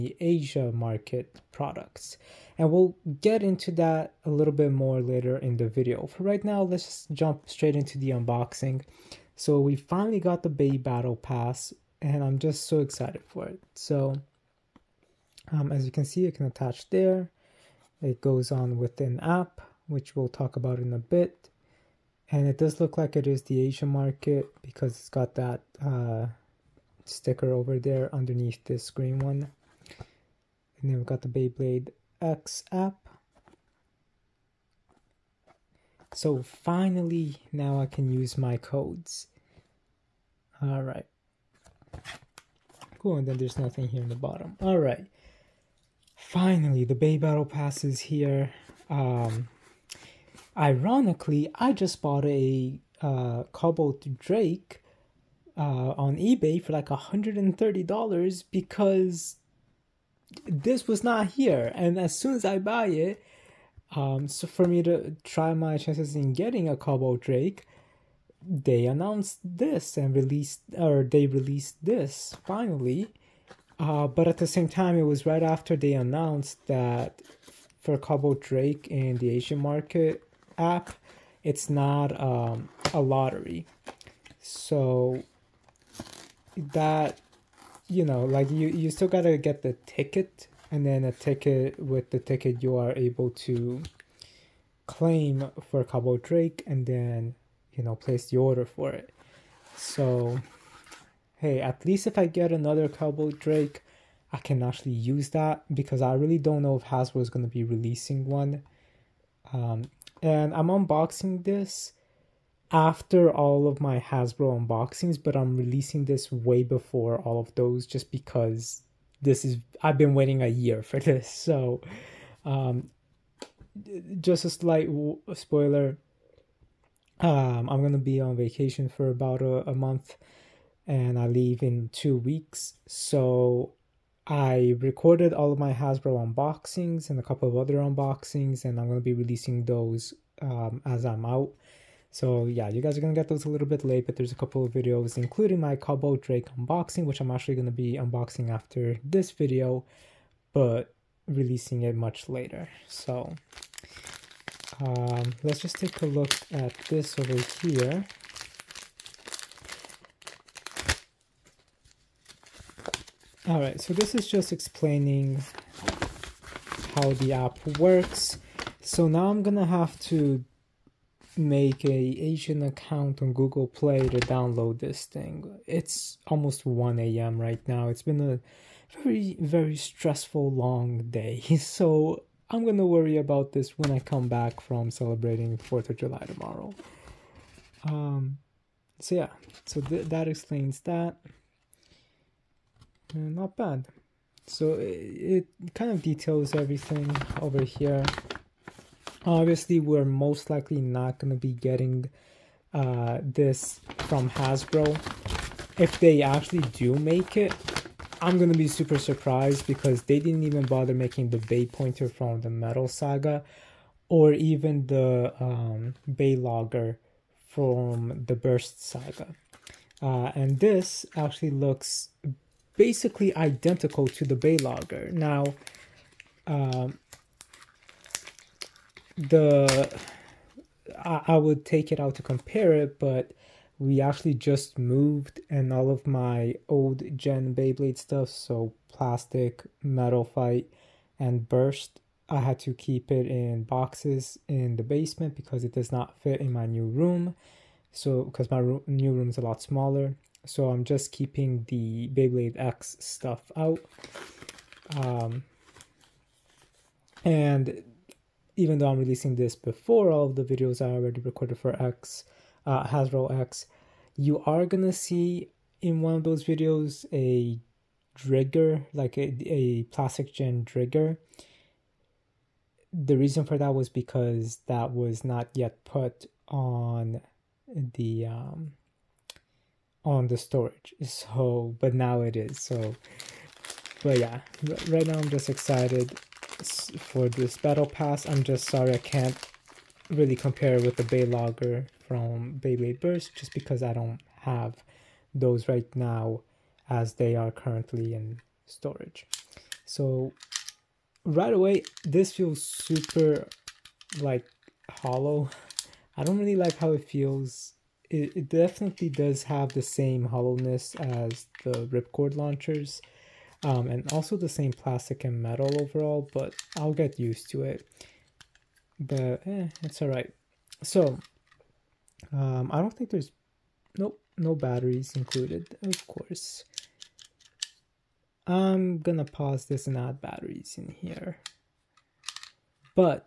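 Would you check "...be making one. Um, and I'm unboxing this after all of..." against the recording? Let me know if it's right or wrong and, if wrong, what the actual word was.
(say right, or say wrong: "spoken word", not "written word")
wrong: "releasing", not "making".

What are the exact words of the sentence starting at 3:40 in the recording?
Uh, and this actually looks basically identical to the Bey Logger.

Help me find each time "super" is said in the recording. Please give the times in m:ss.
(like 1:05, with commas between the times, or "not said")
3:28, 5:02.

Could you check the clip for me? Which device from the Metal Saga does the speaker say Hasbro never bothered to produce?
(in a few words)
Bey Pointer.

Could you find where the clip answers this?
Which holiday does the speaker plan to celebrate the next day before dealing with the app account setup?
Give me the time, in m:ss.
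3:05.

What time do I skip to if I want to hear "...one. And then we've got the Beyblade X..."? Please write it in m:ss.
0:29.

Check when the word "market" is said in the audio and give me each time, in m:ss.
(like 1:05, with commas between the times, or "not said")
0:00, 0:23, 1:19.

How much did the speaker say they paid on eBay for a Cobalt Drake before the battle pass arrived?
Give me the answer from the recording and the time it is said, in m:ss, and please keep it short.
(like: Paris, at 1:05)
$130, at 0:56.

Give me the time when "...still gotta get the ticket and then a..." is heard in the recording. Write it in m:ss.
1:28.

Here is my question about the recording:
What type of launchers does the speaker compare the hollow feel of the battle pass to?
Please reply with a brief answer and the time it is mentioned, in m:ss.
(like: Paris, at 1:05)
ripcord launchers, at 5:11.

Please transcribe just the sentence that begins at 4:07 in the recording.
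So, because my ro- new room is a lot smaller, so I'm just keeping the Beyblade X stuff out.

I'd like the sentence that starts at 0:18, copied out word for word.
It goes on with an app, which we'll talk about in a bit.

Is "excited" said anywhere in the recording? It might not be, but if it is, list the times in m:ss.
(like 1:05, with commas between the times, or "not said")
0:12, 4:45.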